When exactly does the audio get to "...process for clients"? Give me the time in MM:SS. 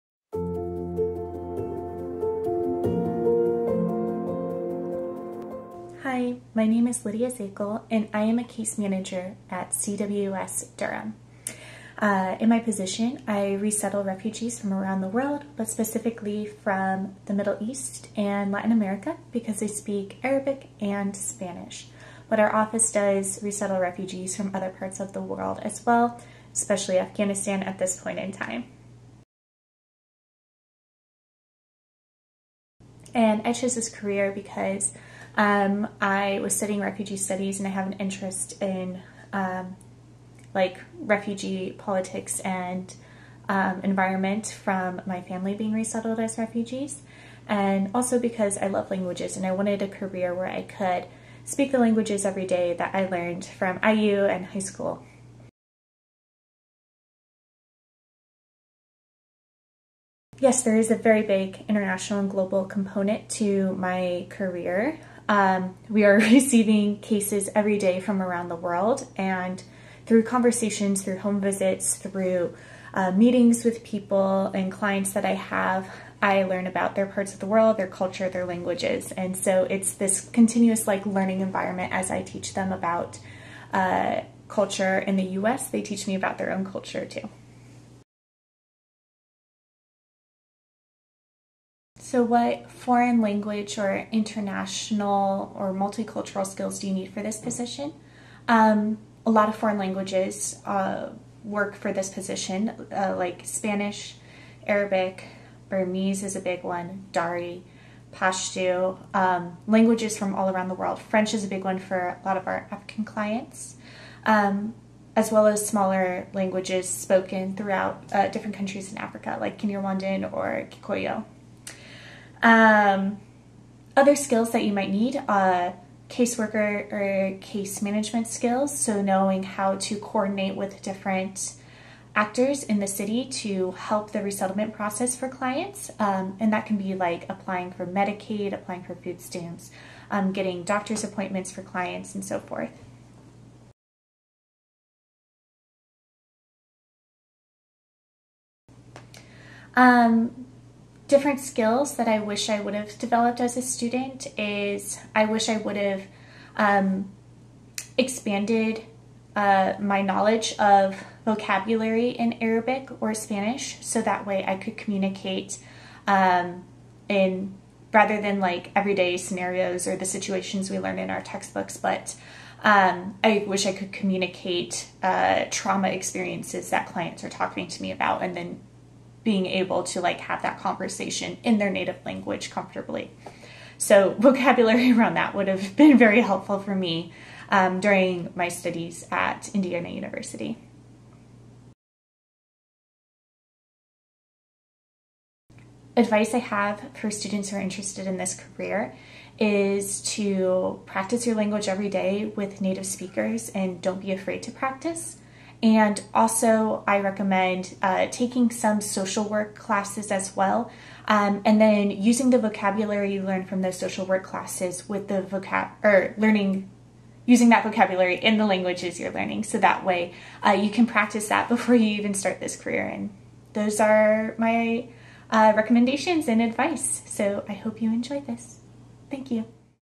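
02:14.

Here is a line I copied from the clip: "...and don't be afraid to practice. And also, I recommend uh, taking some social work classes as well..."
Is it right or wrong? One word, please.
right.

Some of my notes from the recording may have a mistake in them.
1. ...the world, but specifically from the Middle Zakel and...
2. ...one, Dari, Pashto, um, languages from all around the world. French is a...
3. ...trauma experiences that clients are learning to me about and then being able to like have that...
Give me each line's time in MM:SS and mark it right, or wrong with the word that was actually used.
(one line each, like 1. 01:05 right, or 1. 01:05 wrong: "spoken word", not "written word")
1. 00:15 wrong: "East", not "Zakel"
2. 01:46 right
3. 02:55 wrong: "talking", not "learning".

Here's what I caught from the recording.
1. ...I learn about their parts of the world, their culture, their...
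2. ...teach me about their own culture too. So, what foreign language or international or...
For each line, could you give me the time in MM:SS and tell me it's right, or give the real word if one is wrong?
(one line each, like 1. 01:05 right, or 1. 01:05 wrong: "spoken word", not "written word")
1. 01:16 right
2. 01:25 right.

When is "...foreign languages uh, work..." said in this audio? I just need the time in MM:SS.
01:39.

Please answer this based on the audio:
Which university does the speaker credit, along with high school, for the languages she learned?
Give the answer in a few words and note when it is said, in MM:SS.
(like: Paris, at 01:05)
IU, at 00:53.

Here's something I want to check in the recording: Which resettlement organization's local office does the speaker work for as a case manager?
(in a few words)
CWS Durham.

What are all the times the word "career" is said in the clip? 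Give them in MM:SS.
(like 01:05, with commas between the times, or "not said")
00:33, 00:49, 01:04, 03:18, 03:42.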